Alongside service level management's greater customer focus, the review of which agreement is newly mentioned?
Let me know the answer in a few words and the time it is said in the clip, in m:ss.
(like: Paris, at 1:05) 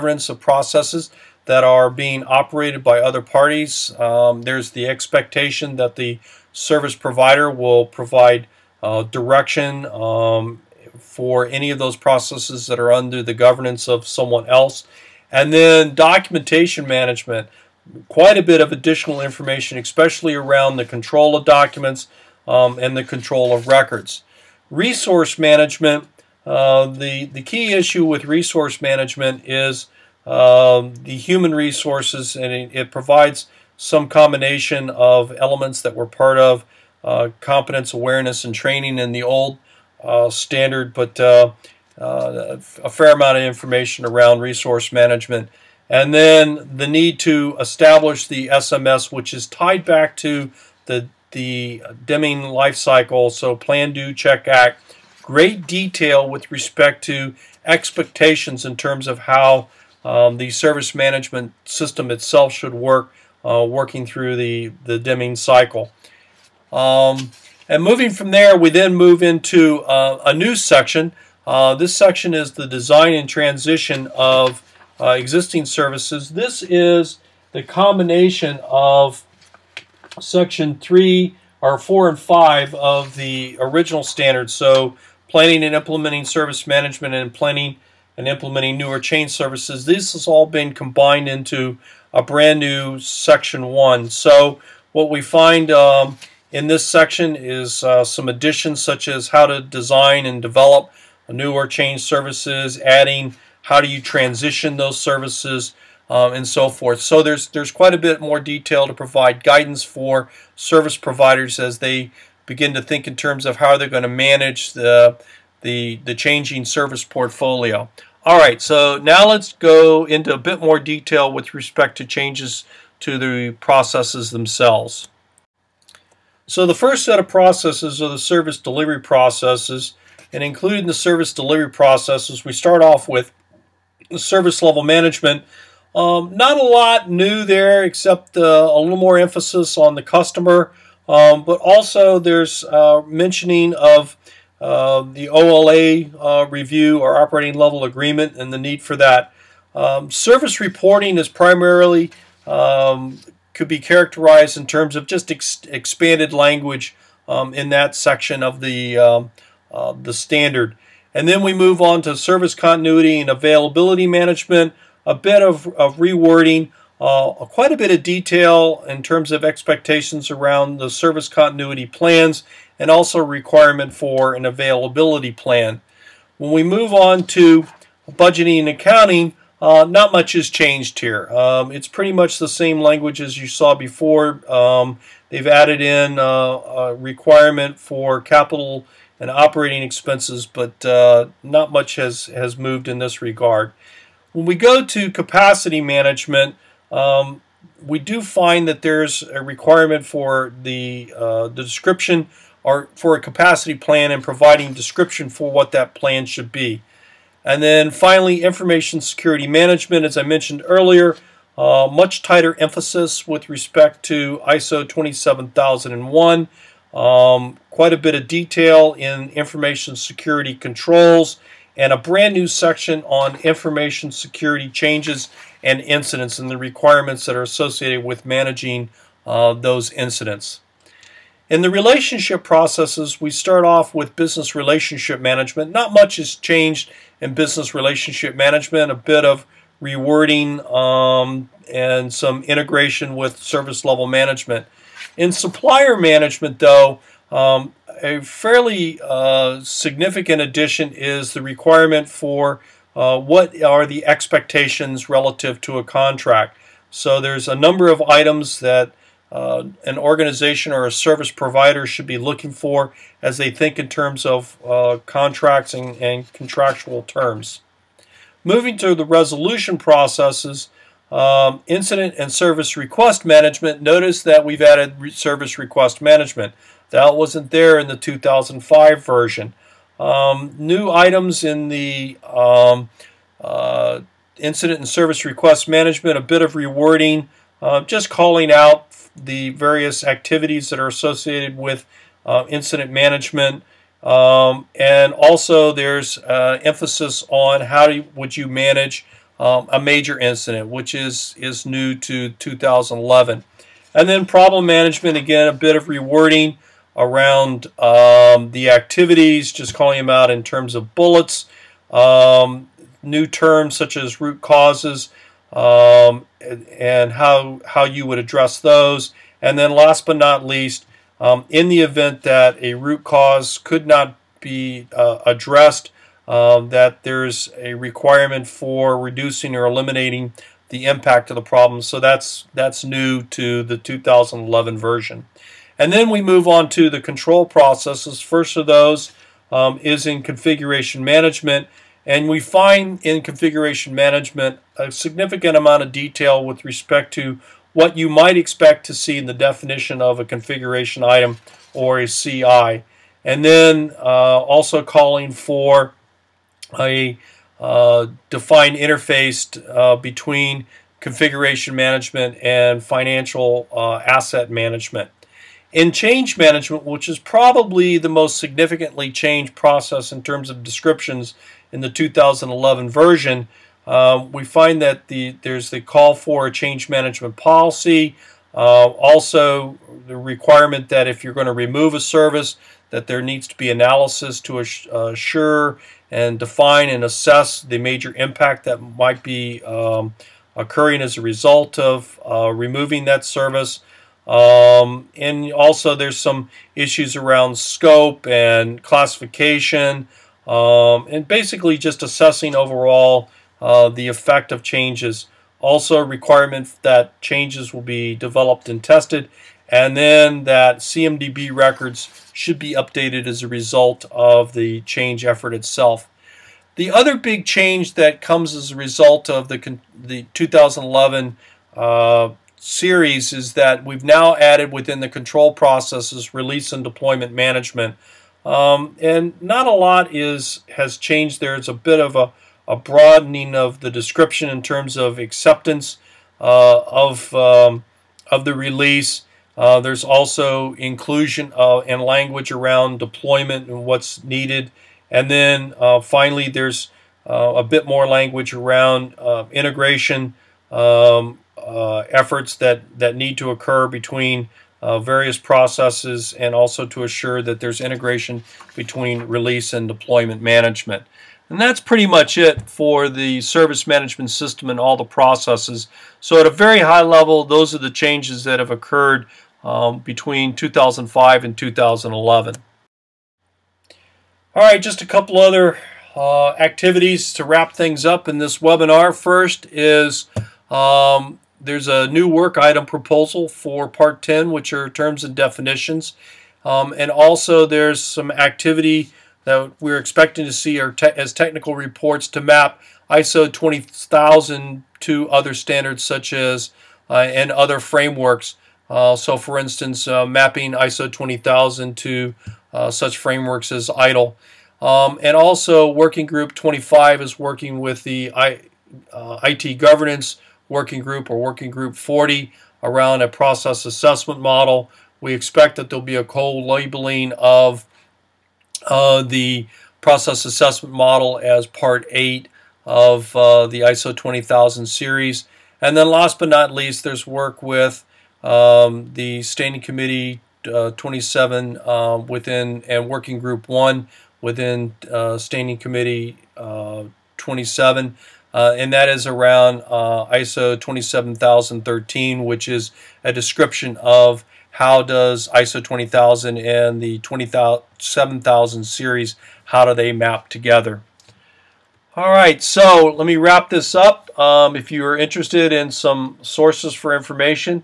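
Operating level agreement, at 2:27.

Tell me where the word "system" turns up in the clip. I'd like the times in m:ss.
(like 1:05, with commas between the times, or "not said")
1:01, 7:44.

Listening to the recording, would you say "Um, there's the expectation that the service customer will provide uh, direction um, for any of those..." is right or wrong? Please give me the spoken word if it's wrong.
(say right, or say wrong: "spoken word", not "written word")
wrong: "provider", not "customer".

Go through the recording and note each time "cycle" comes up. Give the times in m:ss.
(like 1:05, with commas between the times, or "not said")
0:52, 1:05.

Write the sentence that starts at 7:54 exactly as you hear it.
All right, just a couple other uh, activities to wrap things up in this webinar.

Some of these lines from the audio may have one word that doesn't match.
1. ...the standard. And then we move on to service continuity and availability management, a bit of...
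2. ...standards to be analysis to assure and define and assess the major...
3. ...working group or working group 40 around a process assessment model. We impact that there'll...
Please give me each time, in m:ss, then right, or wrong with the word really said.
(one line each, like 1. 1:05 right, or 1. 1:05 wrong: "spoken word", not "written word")
1. 2:39 right
2. 6:23 wrong: "needs", not "standards"
3. 8:30 wrong: "expect", not "impact".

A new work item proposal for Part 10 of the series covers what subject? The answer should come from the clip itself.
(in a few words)
Terms and definitions.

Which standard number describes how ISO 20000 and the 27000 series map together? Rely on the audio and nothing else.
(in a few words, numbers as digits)
ISO 27013.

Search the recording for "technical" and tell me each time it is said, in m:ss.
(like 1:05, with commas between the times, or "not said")
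8:11.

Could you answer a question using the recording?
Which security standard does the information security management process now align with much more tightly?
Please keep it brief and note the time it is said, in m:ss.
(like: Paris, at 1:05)
ISO 27001, at 3:34.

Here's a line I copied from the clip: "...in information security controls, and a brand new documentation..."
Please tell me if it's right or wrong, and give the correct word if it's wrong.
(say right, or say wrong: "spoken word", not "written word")
wrong: "section", not "documentation".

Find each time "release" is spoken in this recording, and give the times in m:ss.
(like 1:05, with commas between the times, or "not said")
7:06, 7:18, 7:39.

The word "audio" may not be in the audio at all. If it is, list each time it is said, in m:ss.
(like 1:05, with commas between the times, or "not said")
not said.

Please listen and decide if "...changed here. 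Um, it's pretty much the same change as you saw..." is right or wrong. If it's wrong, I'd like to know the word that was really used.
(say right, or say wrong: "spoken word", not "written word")
wrong: "language", not "change".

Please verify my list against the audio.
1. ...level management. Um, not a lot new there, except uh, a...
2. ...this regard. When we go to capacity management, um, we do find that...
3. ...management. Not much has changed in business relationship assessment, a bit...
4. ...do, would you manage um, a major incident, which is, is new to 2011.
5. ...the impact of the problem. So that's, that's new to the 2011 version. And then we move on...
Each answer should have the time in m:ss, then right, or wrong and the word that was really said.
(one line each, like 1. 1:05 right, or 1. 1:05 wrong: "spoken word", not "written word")
1. 2:14 right
2. 3:12 right
3. 3:55 wrong: "management", not "assessment"
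4. 4:57 right
5. 5:30 right.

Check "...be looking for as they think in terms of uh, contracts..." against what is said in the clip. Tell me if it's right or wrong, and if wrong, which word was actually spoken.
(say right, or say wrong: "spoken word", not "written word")
right.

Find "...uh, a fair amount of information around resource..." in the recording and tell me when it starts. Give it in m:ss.
0:41.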